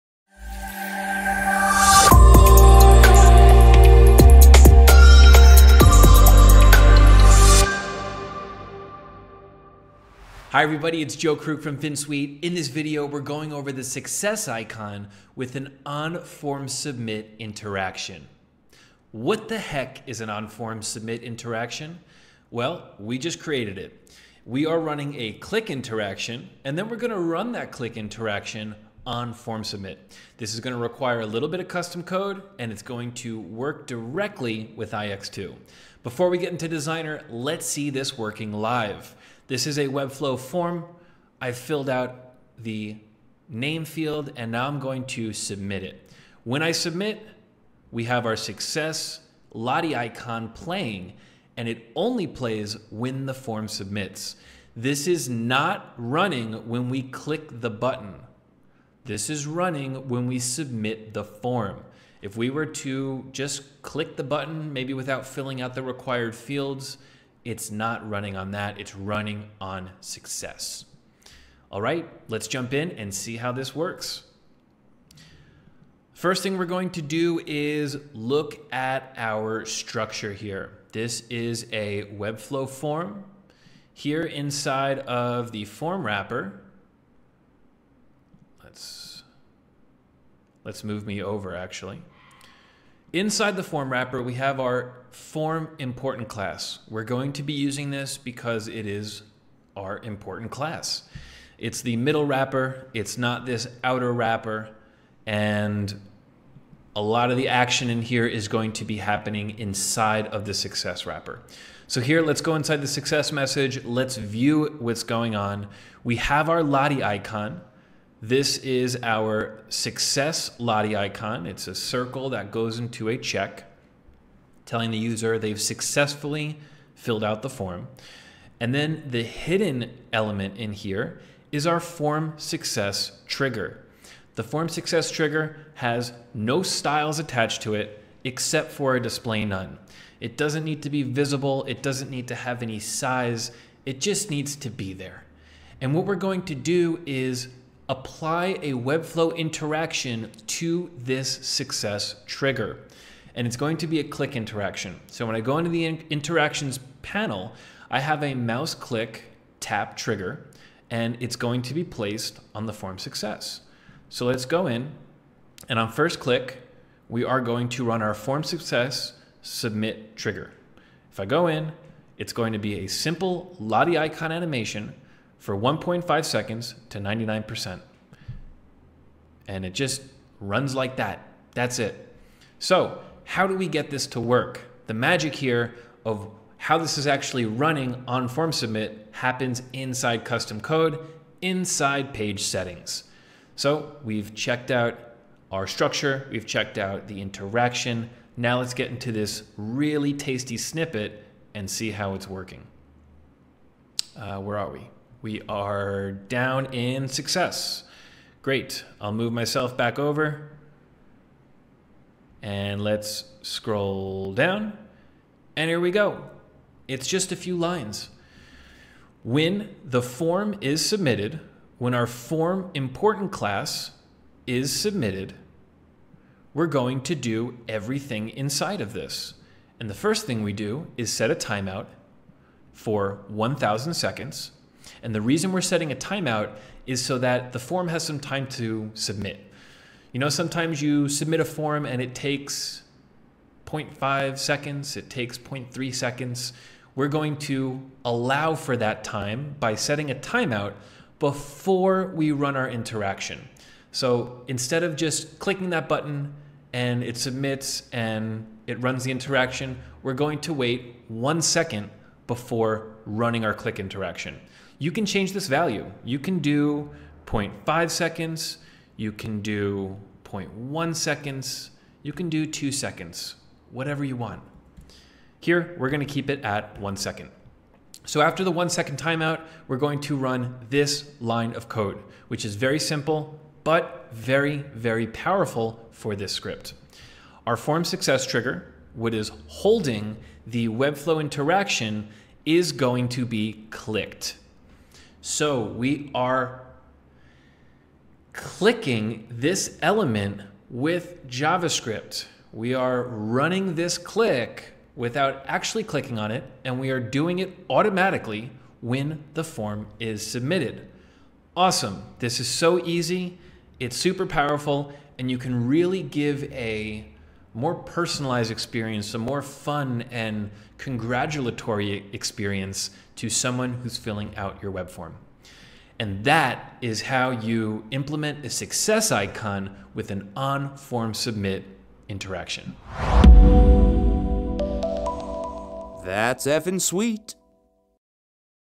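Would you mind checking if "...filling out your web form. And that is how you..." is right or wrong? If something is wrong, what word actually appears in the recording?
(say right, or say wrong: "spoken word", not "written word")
right.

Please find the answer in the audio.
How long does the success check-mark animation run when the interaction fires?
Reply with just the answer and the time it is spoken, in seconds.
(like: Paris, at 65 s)
1.5 seconds, at 175 s.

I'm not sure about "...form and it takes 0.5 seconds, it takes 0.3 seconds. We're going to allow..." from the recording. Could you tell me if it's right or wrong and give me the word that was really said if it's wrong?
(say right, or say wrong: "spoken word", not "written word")
right.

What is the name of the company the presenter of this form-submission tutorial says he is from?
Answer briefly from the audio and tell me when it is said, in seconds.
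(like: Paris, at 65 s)
Finsweet, at 11 s.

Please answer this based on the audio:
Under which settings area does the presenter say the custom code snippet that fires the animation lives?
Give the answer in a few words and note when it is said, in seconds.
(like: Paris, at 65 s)
page settings, at 192 s.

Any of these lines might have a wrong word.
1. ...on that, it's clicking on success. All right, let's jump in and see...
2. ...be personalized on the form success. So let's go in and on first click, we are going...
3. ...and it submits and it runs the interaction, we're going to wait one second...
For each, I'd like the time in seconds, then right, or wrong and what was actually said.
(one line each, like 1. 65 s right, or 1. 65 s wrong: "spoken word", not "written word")
1. 68 s wrong: "running", not "clicking"
2. 161 s wrong: "placed", not "personalized"
3. 256 s right.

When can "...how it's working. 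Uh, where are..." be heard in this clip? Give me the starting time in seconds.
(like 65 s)
201 s.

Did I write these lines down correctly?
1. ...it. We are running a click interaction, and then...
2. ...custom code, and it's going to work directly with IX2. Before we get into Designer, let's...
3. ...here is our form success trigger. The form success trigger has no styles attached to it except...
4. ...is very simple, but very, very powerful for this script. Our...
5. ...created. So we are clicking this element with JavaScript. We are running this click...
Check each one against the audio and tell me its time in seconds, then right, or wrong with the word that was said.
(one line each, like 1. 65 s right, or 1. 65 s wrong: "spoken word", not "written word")
1. 23 s right
2. 31 s right
3. 130 s right
4. 282 s right
5. 293 s wrong: "clicked", not "created".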